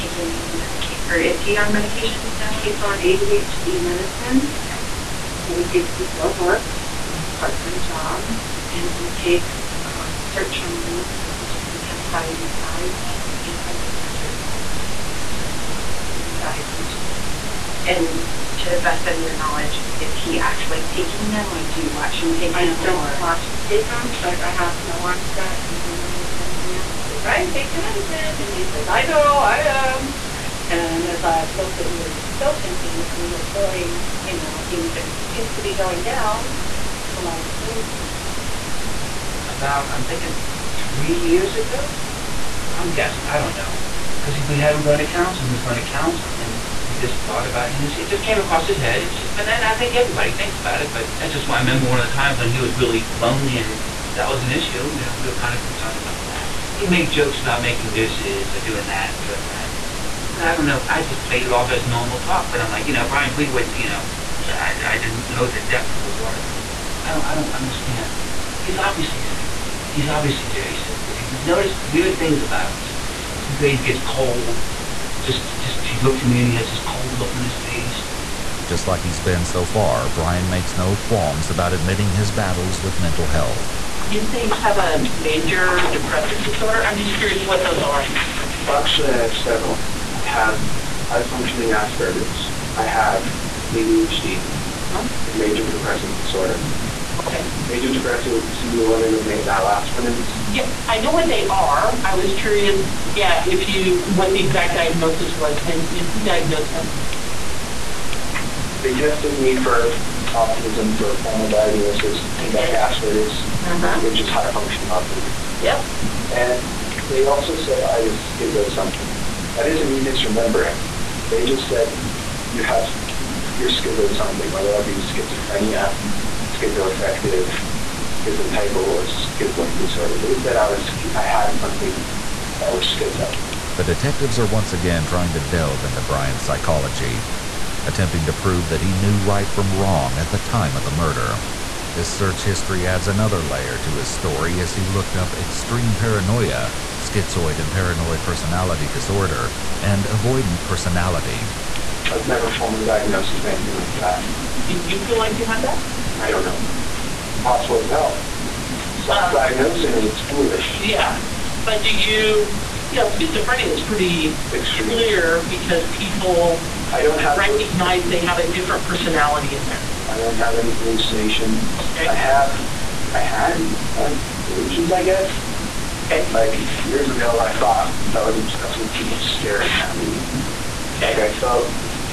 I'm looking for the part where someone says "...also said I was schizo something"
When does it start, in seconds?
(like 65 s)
117 s.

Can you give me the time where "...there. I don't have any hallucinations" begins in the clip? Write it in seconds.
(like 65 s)
169 s.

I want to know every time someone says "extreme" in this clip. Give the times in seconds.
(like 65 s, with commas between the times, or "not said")
145 s, 164 s.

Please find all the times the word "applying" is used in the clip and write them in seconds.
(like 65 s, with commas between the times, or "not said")
not said.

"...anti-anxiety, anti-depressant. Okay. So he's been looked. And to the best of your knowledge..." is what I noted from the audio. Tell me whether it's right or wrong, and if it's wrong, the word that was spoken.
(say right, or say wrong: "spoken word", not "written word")
wrong: "diagnosed", not "looked".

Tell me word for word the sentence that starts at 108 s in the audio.
They tested me for autism for a formal diagnosis, okay.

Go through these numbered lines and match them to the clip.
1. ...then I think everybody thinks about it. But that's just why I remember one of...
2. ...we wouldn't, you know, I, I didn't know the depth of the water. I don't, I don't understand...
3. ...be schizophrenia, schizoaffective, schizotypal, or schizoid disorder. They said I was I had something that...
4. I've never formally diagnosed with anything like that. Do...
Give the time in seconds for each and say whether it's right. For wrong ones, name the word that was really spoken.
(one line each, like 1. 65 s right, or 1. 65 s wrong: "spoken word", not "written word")
1. 49 s right
2. 63 s right
3. 124 s right
4. 152 s right.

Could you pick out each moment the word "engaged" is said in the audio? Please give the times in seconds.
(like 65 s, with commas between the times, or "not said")
not said.